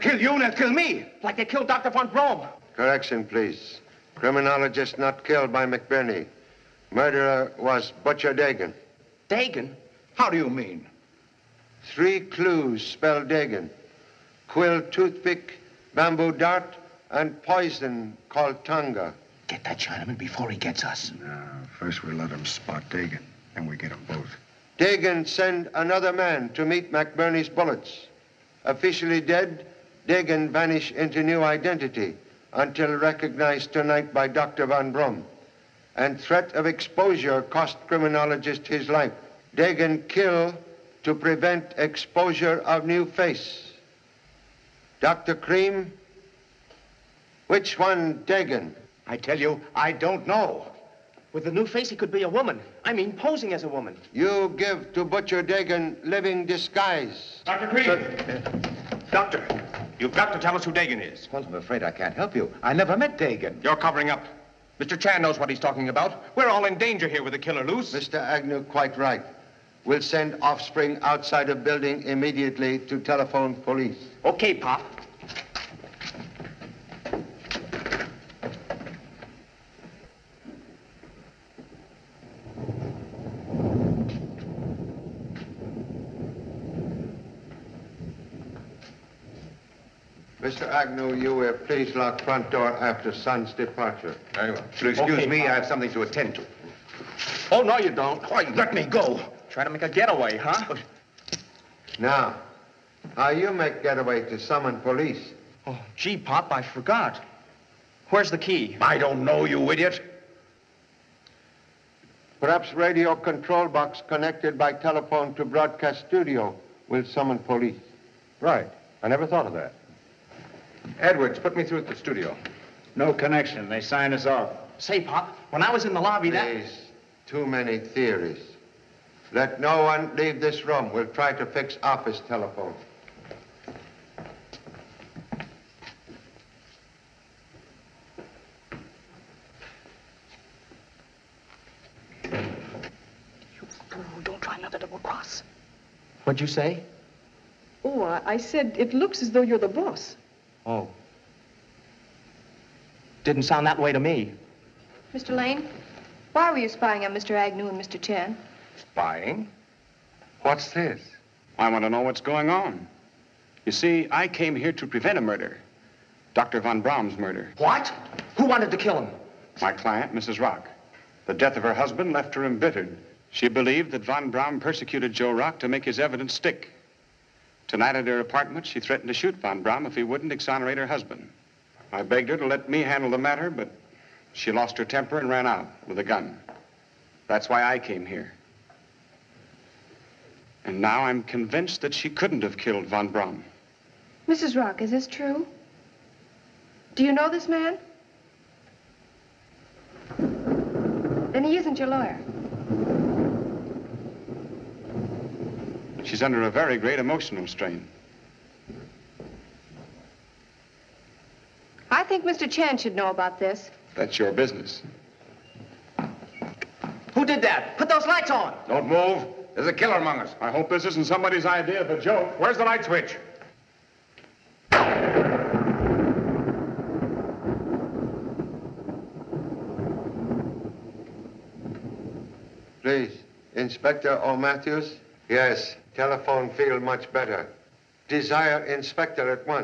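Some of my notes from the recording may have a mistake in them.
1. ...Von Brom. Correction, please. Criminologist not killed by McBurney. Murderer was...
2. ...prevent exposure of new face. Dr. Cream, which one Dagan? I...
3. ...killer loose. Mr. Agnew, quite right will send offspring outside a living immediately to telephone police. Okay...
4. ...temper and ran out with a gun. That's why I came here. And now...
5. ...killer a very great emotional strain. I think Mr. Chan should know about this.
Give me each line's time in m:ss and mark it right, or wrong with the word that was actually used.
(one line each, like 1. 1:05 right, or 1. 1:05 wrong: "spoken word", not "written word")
1. 0:01 right
2. 0:41 right
3. 1:07 wrong: "building", not "living"
4. 3:04 right
5. 3:26 wrong: "under", not "killer".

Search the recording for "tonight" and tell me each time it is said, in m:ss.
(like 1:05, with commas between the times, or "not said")
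0:33, 2:57.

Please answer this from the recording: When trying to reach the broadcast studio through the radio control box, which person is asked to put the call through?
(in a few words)
Edwards.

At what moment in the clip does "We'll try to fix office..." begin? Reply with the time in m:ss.
2:10.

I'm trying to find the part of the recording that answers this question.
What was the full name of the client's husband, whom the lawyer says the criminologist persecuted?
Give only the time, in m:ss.
2:55.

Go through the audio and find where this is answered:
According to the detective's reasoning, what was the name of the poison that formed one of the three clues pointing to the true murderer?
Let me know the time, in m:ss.
0:18.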